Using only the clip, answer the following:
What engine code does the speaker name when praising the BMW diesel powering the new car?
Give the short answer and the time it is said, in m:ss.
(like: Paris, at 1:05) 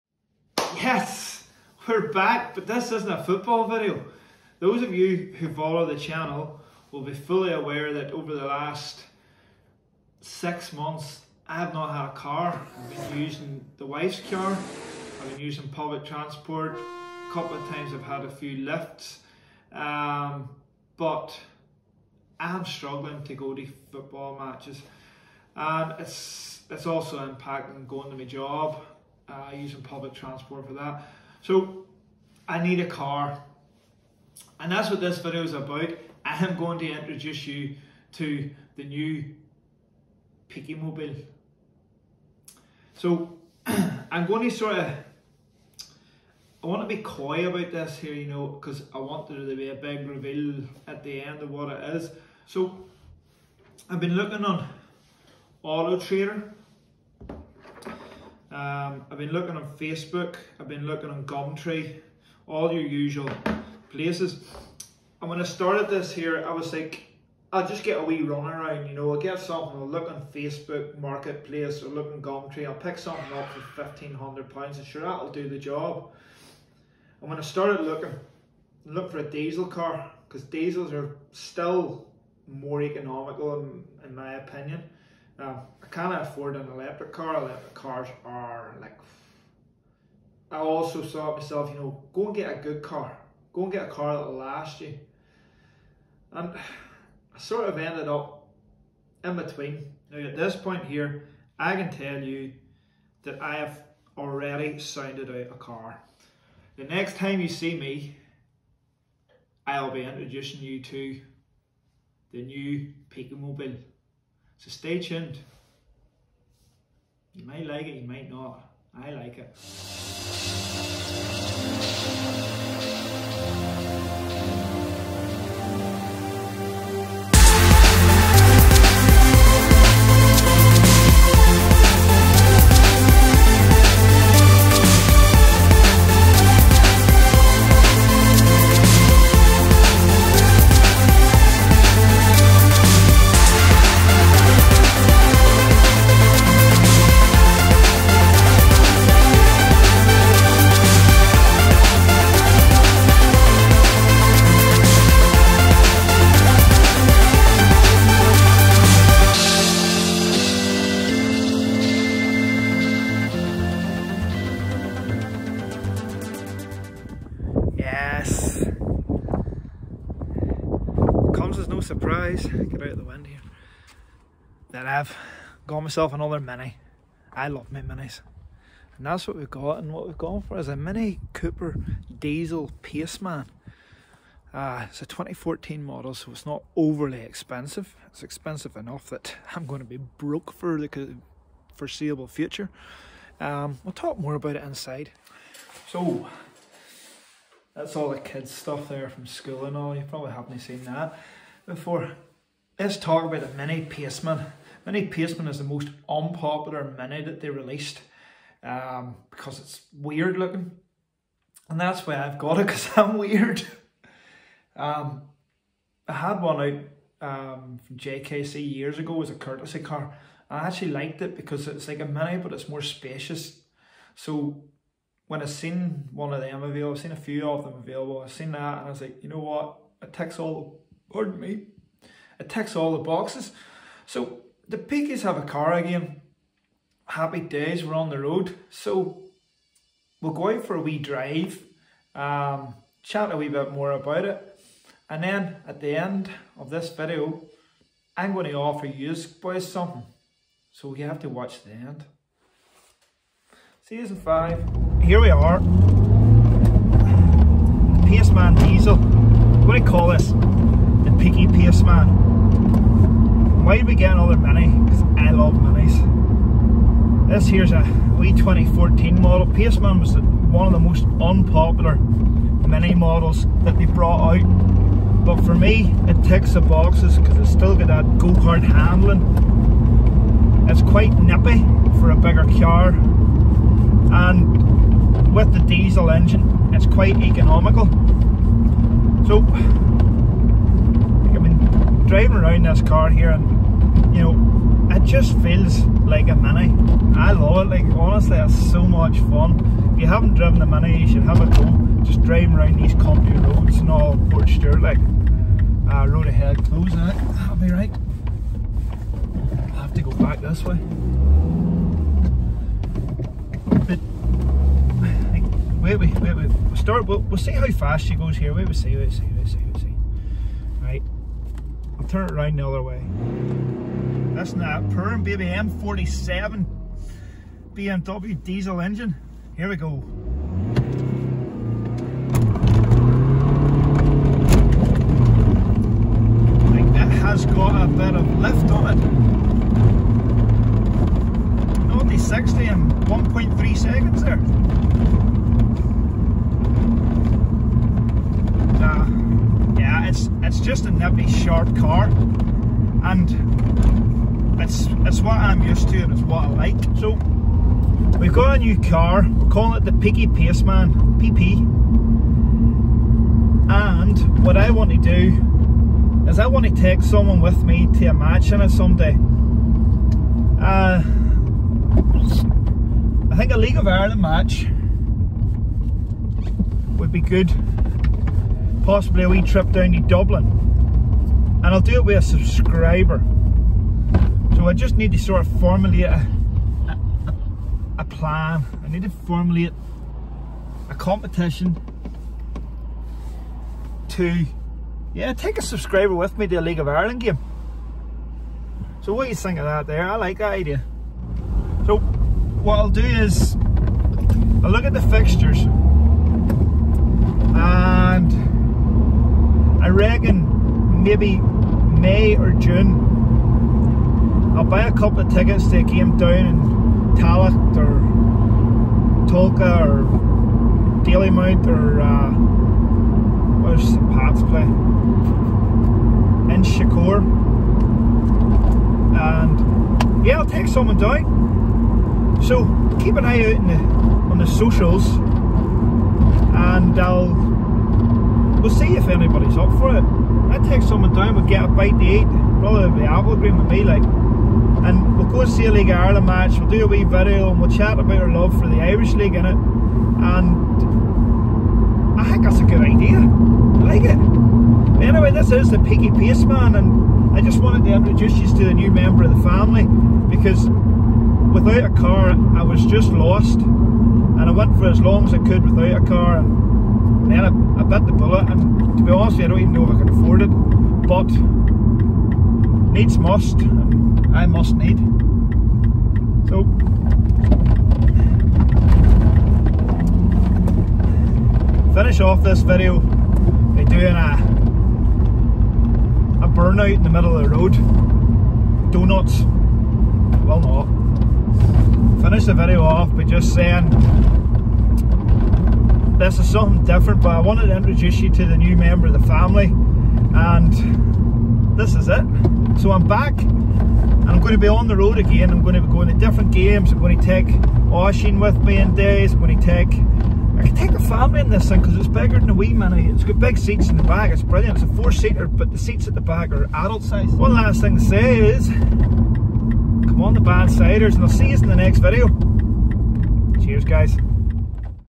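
M47, at 5:25.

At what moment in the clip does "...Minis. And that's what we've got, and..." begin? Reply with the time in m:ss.
2:57.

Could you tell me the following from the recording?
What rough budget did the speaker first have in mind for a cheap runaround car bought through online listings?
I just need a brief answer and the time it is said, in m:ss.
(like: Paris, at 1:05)
£1,500, at 1:13.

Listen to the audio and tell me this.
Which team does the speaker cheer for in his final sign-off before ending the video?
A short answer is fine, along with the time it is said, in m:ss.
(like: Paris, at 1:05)
the Bannsiders, at 8:40.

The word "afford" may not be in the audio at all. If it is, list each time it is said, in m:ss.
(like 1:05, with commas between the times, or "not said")
1:26, 7:50.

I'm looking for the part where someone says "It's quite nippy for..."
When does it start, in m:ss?
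4:40.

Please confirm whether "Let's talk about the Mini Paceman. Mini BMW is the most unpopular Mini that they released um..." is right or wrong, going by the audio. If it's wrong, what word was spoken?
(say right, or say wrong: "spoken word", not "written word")
wrong: "Paceman", not "BMW".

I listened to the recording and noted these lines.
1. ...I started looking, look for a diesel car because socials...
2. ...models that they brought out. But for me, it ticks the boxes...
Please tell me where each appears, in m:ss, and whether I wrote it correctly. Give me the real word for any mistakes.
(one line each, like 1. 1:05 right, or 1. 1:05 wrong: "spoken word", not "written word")
1. 1:17 wrong: "diesels", not "socials"
2. 4:32 right.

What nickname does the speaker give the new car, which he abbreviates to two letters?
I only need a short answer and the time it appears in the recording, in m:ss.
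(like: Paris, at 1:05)
Peaky Paceman, at 5:59.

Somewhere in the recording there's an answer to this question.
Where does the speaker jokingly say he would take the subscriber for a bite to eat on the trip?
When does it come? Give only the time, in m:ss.
7:23.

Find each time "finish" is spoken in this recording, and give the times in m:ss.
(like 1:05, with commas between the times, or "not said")
8:01, 8:12.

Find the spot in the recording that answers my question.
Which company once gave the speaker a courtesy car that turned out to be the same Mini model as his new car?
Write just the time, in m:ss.
3:37.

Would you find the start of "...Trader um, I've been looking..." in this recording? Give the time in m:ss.
0:55.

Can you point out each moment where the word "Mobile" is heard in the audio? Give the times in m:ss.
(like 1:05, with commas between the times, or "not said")
0:40, 1:53.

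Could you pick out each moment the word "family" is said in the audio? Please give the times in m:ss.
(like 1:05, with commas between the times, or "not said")
7:39, 8:19, 8:30.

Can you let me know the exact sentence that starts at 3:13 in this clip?
Um, we'll talk more about it inside.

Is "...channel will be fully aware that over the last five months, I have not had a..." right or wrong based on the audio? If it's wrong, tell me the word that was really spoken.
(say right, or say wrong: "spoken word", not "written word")
wrong: "six", not "five".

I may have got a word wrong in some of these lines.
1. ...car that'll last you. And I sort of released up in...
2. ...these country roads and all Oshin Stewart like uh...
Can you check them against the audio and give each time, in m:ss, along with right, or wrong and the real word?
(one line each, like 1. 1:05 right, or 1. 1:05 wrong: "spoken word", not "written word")
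1. 1:33 wrong: "ended", not "released"
2. 5:02 wrong: "Port", not "Oshin".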